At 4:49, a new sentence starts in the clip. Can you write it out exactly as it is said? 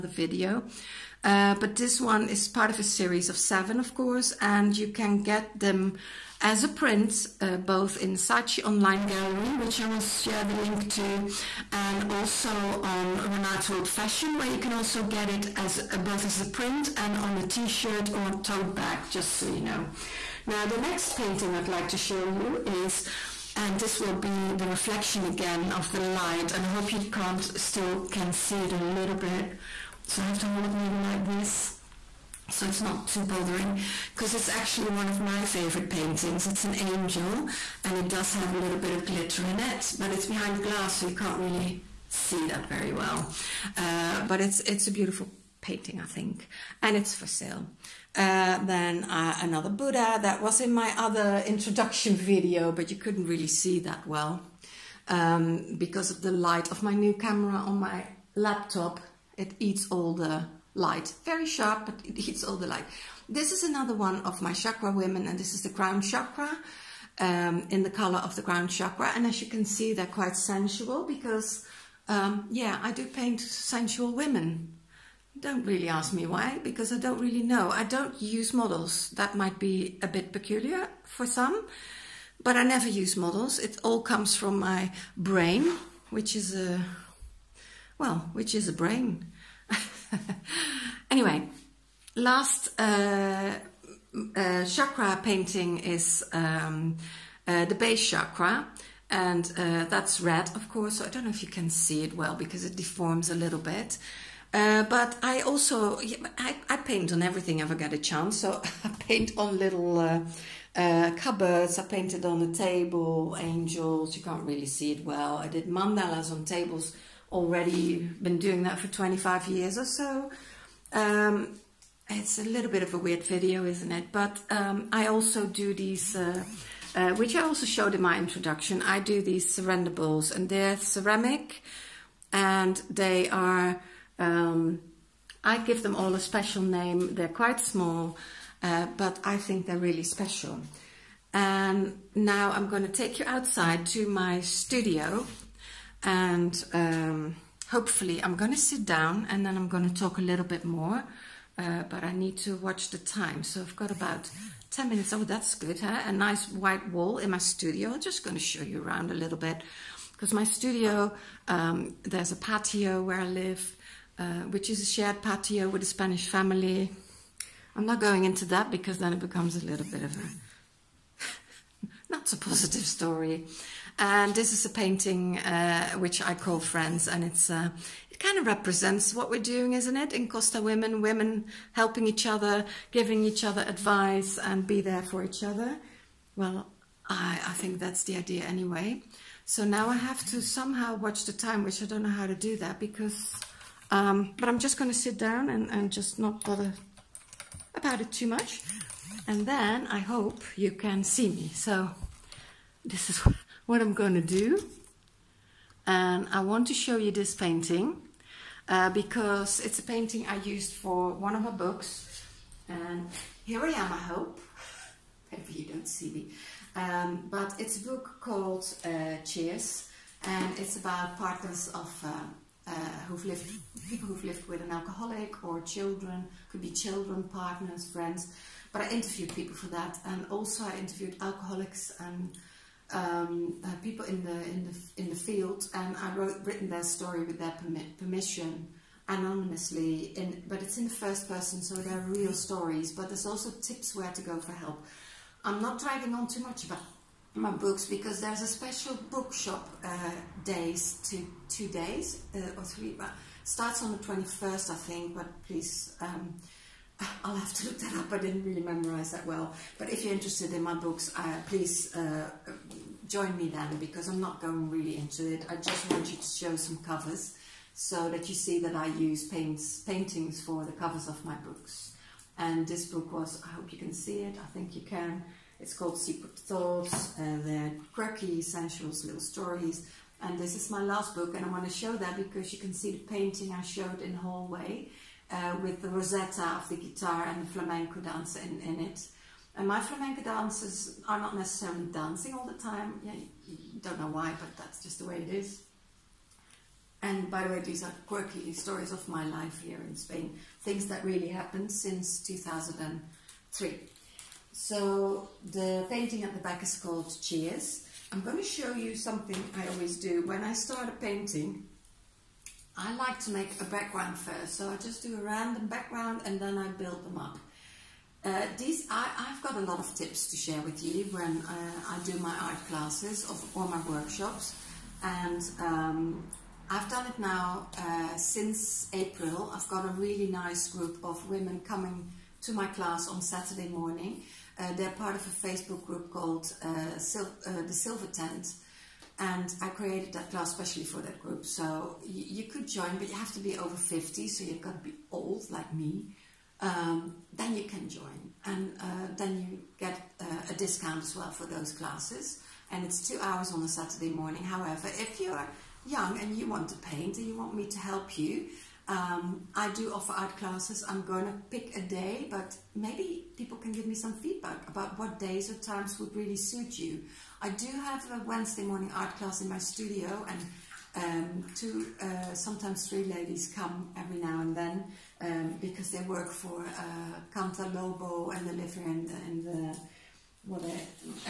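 And my flamenco dancers are not necessarily dancing all the time.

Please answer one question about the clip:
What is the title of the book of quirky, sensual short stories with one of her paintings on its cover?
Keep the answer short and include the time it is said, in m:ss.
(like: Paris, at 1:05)
Secret Thoughts, at 4:35.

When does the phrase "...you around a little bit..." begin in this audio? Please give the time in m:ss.
2:38.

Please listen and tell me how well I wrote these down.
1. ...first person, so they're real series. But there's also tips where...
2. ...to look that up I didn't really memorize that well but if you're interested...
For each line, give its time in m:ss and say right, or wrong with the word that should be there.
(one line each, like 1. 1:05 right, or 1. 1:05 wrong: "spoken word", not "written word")
1. 4:00 wrong: "stories", not "series"
2. 4:17 right.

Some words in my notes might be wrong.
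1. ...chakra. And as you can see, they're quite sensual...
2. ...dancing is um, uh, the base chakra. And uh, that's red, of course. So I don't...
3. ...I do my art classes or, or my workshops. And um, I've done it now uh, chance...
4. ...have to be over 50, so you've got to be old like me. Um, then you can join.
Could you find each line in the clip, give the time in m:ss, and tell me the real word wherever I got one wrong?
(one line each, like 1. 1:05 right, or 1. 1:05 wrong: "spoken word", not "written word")
1. 1:08 right
2. 1:35 wrong: "painting", not "dancing"
3. 5:21 wrong: "since", not "chance"
4. 5:43 right.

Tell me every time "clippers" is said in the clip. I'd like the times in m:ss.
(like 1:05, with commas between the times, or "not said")
not said.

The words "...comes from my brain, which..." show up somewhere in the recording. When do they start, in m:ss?
1:24.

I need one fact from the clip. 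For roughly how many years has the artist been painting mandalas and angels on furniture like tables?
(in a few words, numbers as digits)
25.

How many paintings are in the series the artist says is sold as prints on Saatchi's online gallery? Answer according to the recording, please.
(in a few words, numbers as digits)
7.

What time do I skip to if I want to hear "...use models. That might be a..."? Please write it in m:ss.
1:18.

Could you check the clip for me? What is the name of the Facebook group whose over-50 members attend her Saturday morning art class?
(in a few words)
The Silver Tent.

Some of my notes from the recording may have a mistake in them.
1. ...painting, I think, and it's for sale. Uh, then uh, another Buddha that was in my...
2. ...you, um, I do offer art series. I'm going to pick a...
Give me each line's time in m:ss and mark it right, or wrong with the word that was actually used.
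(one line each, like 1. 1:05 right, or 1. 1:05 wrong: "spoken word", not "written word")
1. 0:45 right
2. 5:58 wrong: "classes", not "series".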